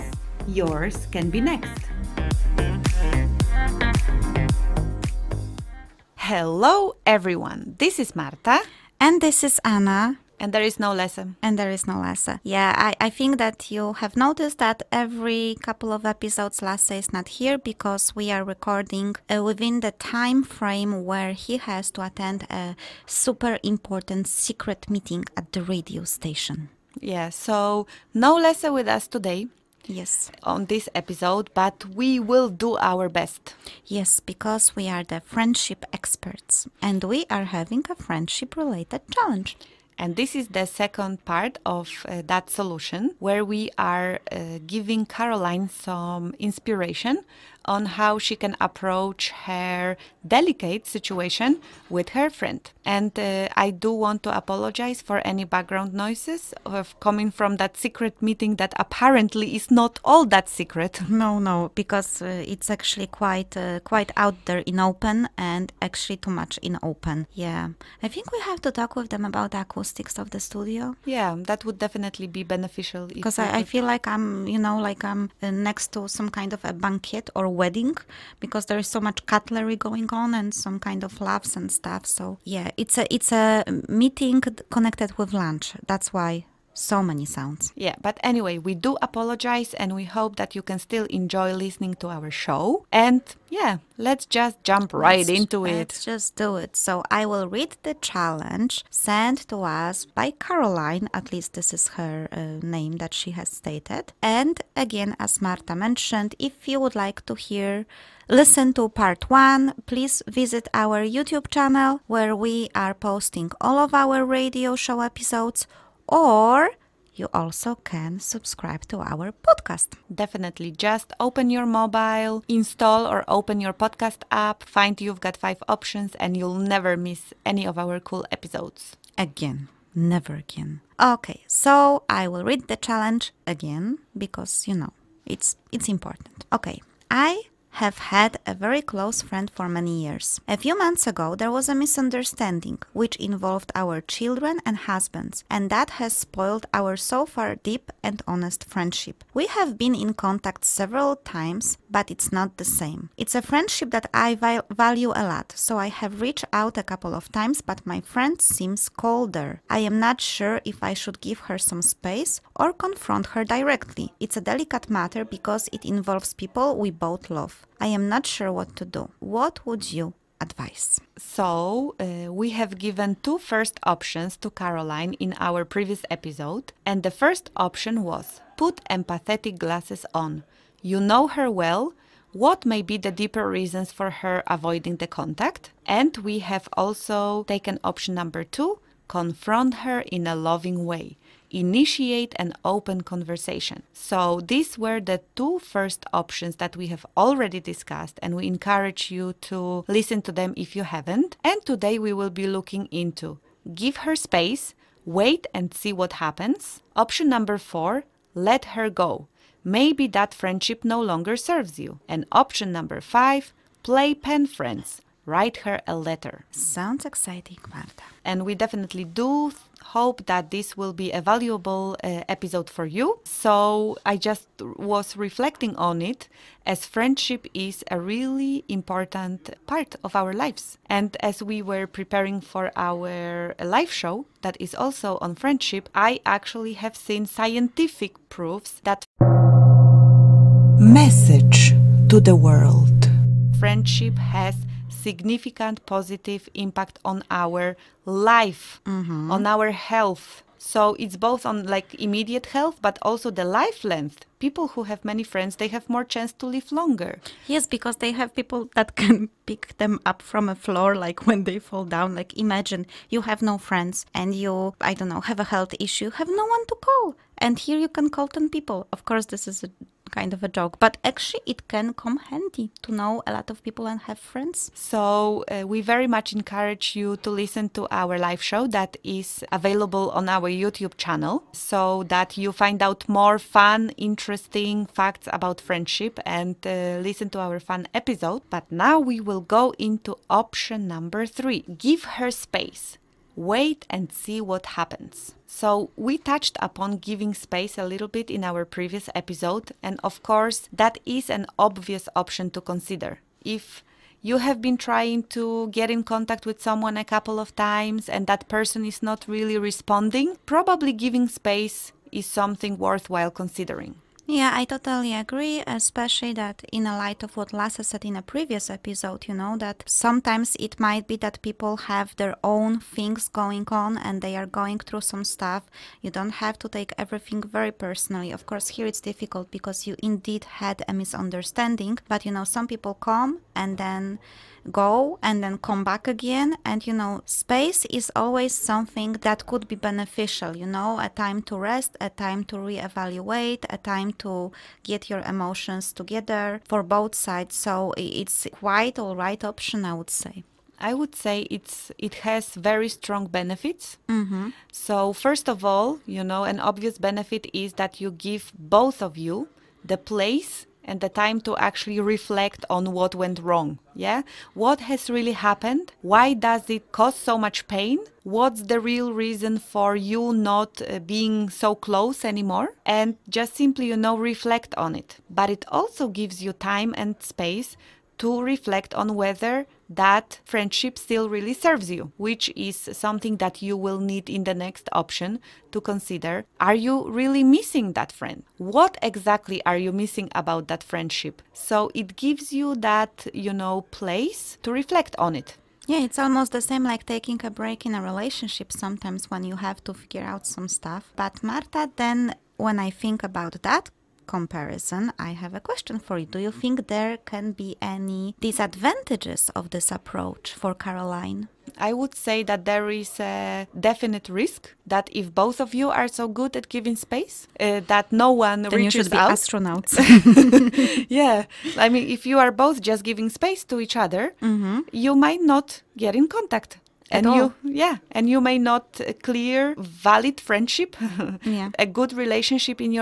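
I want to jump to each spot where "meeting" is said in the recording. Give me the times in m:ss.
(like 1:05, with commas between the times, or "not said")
0:24, 0:58, 1:23.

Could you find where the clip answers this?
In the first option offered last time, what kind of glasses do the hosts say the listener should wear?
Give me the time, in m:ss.
2:58.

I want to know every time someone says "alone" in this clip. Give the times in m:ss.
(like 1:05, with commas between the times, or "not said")
not said.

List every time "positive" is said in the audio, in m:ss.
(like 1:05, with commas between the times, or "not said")
4:05.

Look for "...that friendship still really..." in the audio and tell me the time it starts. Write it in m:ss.
6:19.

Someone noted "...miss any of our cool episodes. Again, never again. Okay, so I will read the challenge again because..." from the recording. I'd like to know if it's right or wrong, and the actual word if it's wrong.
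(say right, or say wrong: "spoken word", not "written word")
right.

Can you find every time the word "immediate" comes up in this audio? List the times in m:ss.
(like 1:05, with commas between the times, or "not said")
4:11.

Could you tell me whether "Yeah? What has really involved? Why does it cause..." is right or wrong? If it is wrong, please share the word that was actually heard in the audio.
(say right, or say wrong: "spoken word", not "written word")
wrong: "happened", not "involved".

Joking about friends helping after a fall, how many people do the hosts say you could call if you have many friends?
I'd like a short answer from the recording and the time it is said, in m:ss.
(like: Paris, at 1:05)
10, at 4:28.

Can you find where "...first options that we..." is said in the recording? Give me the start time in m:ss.
3:15.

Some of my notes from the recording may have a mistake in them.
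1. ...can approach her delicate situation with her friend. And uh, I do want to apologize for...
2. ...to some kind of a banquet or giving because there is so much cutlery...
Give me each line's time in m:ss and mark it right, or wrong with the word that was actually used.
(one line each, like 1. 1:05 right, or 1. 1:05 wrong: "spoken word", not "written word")
1. 0:48 right
2. 1:15 wrong: "wedding", not "giving".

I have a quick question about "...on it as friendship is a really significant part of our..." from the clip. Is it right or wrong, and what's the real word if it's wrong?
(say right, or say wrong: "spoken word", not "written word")
wrong: "important", not "significant".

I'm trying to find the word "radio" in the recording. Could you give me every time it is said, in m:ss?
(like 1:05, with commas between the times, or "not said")
0:25, 1:54.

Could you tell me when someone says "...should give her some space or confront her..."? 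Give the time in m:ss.
2:40.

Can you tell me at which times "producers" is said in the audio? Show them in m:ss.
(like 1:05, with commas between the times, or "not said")
not said.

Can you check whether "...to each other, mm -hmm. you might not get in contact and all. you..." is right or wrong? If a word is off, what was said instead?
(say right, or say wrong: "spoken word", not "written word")
right.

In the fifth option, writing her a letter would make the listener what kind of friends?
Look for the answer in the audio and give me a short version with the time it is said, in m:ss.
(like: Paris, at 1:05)
Pen friends, at 3:34.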